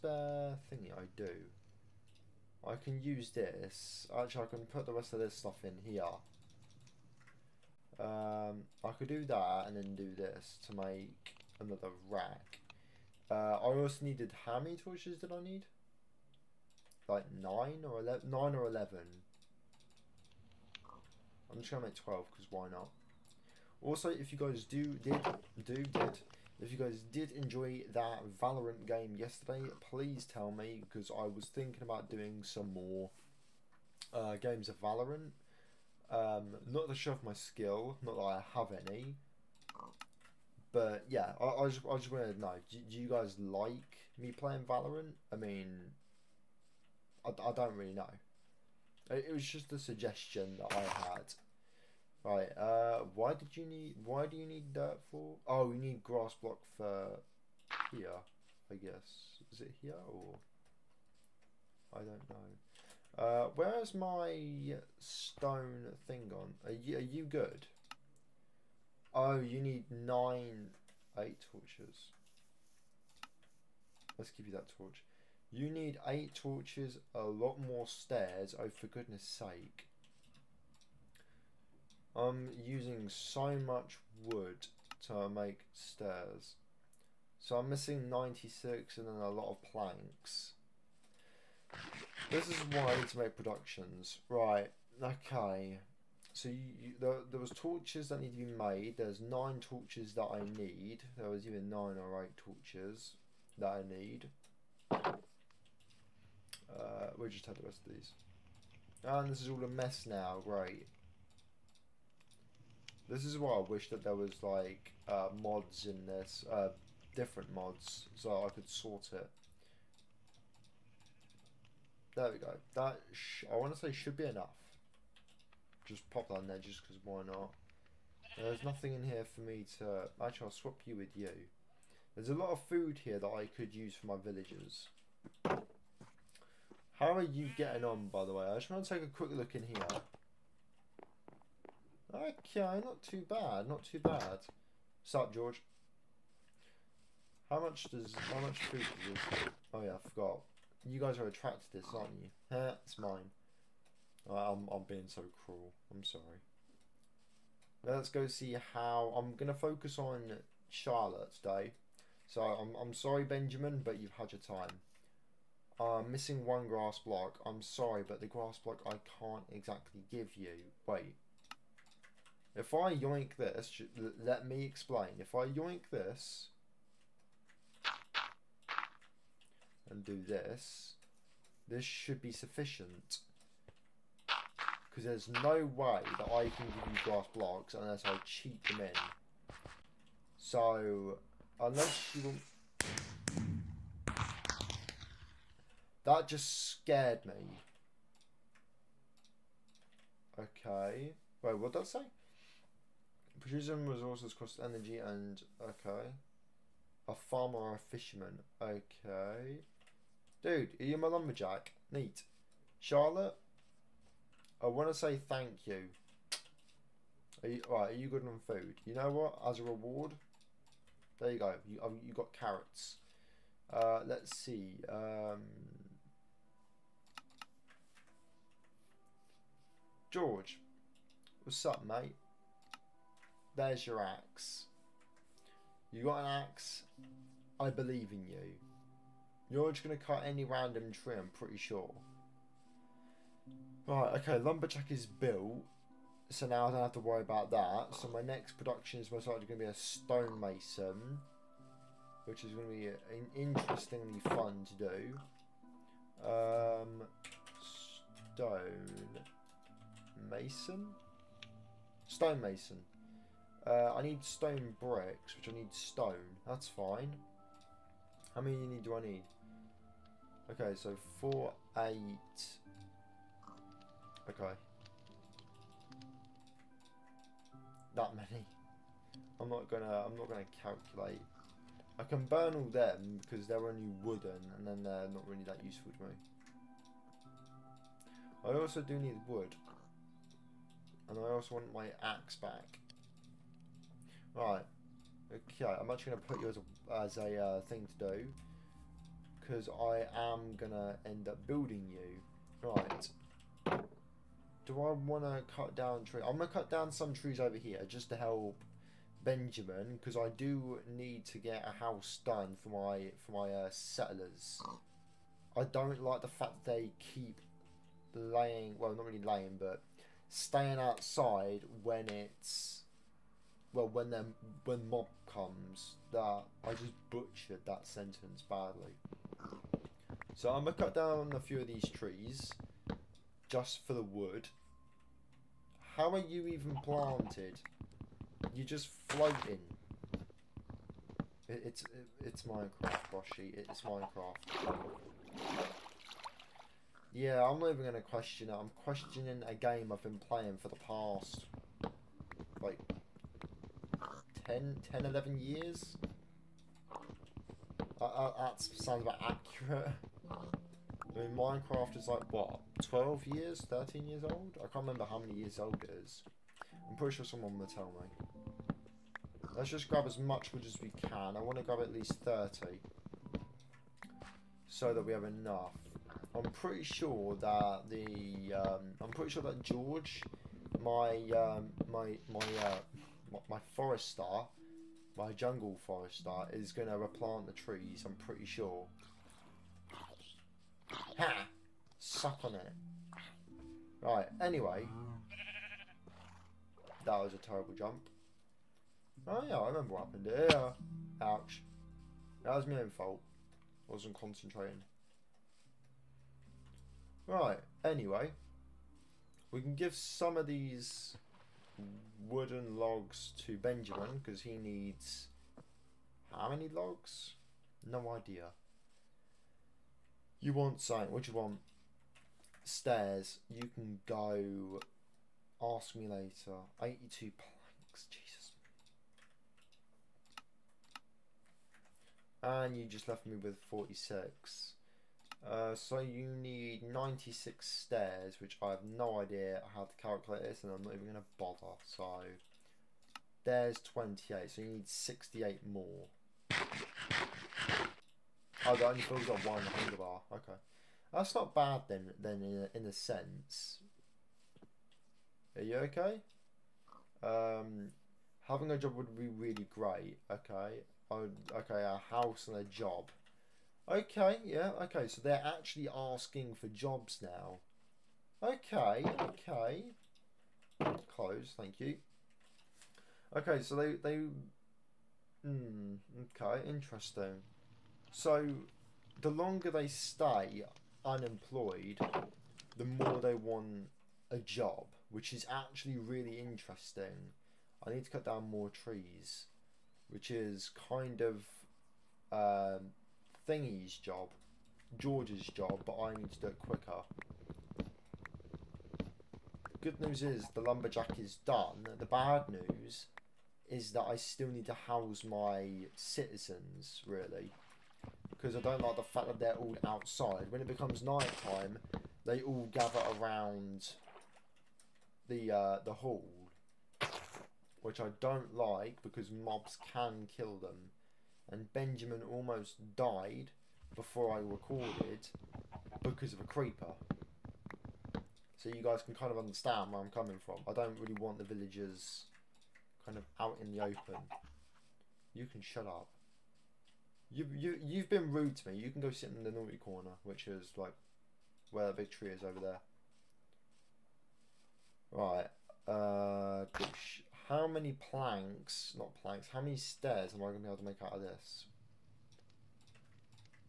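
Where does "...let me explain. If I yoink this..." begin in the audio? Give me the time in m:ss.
2:54.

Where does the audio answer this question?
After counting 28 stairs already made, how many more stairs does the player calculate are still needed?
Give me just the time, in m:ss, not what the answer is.
7:24.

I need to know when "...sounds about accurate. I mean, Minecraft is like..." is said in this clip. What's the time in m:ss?
5:58.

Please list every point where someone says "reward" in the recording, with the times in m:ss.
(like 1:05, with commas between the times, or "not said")
3:39.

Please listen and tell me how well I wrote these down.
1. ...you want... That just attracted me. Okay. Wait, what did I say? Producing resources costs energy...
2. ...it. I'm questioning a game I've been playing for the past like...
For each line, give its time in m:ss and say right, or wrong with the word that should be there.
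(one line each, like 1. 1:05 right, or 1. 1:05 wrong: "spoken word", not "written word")
1. 3:12 wrong: "scared", not "attracted"
2. 5:48 right.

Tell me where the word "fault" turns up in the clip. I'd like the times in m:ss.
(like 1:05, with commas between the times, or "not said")
6:42.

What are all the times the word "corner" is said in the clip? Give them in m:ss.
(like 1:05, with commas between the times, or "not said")
8:59.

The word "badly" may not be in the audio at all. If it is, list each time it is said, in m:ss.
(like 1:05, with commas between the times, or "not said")
5:28.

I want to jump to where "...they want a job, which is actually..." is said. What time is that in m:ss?
8:03.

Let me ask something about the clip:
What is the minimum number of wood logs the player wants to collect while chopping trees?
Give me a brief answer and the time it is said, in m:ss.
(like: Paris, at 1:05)
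30, at 6:12.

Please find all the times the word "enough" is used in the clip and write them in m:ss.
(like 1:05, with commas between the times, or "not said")
2:04, 6:15.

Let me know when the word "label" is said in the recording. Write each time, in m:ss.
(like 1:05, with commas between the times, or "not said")
not said.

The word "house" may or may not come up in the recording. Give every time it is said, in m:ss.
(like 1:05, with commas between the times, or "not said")
5:11, 7:42, 8:24.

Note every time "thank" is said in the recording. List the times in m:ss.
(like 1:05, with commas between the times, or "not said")
3:35, 7:51.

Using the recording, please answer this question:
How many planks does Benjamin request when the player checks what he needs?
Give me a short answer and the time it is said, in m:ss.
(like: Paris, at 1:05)
82, at 7:06.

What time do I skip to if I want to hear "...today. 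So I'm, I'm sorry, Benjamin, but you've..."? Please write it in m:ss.
2:41.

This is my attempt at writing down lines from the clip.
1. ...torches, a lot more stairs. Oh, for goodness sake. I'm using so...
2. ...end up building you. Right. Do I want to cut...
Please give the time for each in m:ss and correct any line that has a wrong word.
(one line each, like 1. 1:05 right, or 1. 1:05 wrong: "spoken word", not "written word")
1. 1:16 right
2. 5:01 right.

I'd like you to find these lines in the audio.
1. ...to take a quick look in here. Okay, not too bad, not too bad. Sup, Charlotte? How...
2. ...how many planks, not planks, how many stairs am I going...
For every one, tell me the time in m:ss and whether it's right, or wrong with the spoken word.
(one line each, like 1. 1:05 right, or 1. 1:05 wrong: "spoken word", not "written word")
1. 2:18 wrong: "George", not "Charlotte"
2. 9:07 right.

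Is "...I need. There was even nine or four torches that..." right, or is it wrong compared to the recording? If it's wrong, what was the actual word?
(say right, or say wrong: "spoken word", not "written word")
wrong: "eight", not "four".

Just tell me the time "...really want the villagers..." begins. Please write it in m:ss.
8:50.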